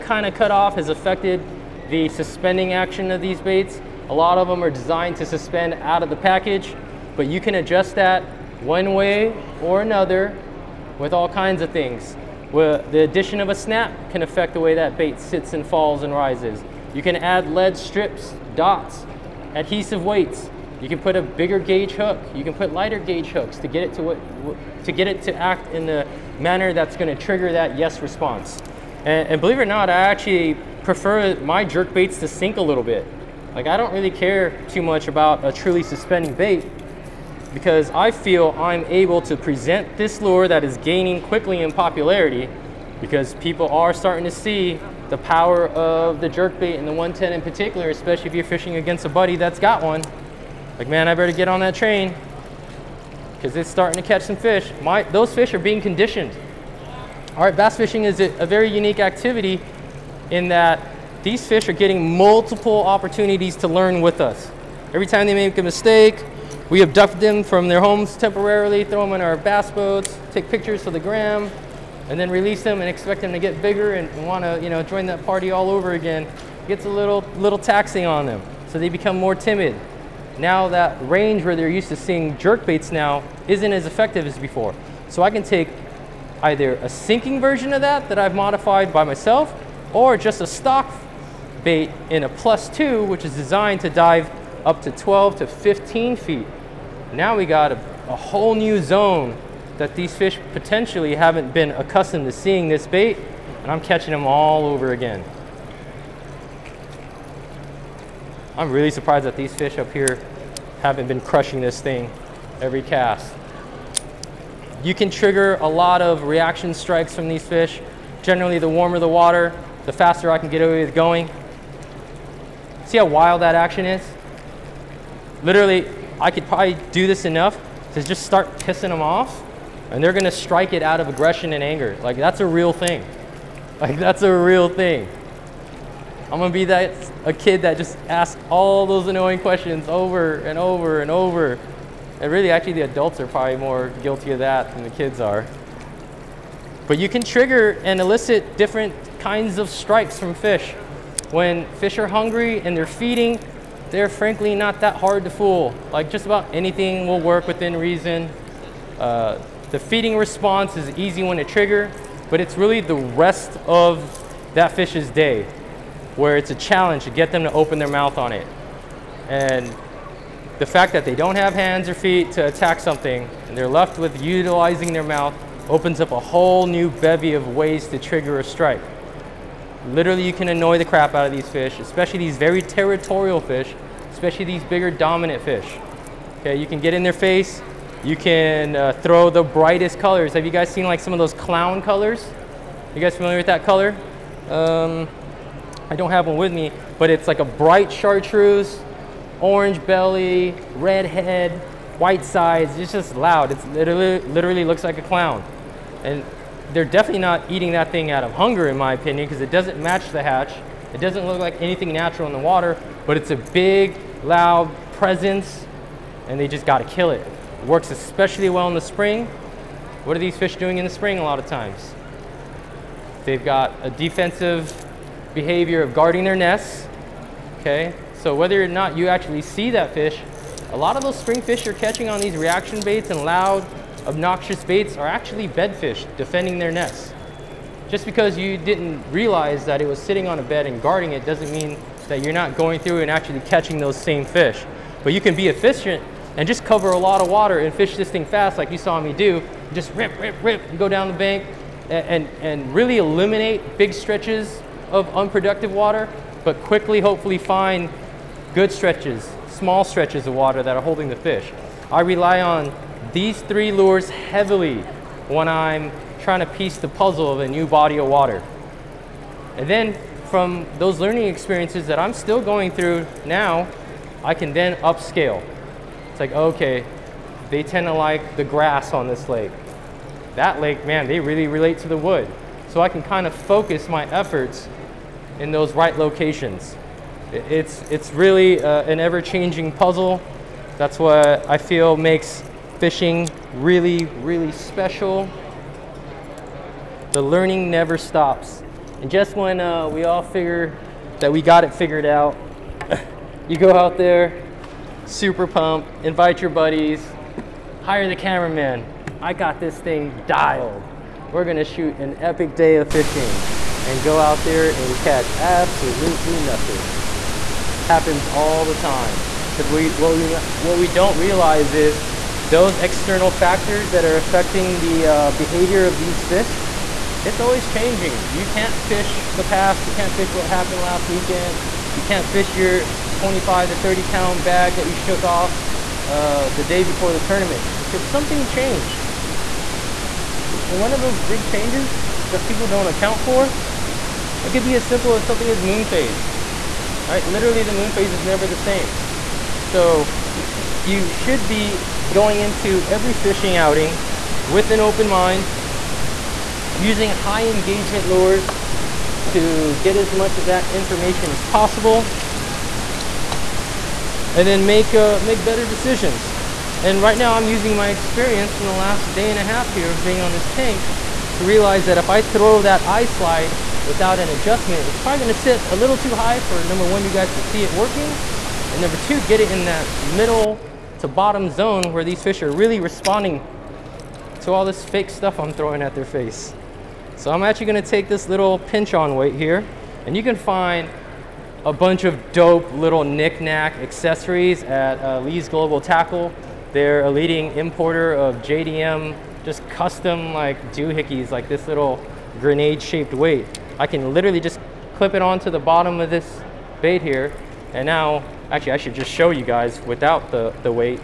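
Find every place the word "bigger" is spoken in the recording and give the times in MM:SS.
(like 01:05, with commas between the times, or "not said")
00:21, 01:13, 03:04.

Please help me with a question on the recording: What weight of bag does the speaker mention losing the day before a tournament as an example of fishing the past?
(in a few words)
25 to 30 pounds.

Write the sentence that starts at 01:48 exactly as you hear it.
I'm really surprised that these fish up here haven't been crushing this thing every cast.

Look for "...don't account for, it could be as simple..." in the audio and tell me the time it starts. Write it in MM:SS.
05:42.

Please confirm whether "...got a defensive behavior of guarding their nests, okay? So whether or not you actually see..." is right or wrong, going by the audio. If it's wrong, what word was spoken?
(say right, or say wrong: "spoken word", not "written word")
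right.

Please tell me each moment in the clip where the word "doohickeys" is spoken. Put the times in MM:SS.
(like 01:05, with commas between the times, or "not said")
06:40.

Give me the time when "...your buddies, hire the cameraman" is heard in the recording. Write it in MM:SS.
05:06.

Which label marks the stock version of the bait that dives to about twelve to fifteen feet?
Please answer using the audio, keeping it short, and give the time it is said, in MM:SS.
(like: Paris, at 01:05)
plus two, at 01:32.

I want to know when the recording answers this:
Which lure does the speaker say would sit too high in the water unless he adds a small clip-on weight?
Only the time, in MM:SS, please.
06:12.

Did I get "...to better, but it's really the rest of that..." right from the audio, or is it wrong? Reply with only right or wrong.
wrong.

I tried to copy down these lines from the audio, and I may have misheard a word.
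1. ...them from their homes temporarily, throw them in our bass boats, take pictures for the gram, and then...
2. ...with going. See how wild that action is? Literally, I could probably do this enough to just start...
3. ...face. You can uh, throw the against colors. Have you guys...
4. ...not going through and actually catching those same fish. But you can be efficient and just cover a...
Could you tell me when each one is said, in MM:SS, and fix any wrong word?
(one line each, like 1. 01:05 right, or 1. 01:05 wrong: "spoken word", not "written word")
1. 01:07 right
2. 02:00 right
3. 03:07 wrong: "brightest", not "against"
4. 04:02 right.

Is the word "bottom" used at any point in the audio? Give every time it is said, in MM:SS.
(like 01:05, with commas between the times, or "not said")
06:21, 06:45.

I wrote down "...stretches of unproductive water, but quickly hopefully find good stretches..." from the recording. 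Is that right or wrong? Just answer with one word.
right.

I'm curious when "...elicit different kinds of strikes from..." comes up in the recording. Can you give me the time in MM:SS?
02:27.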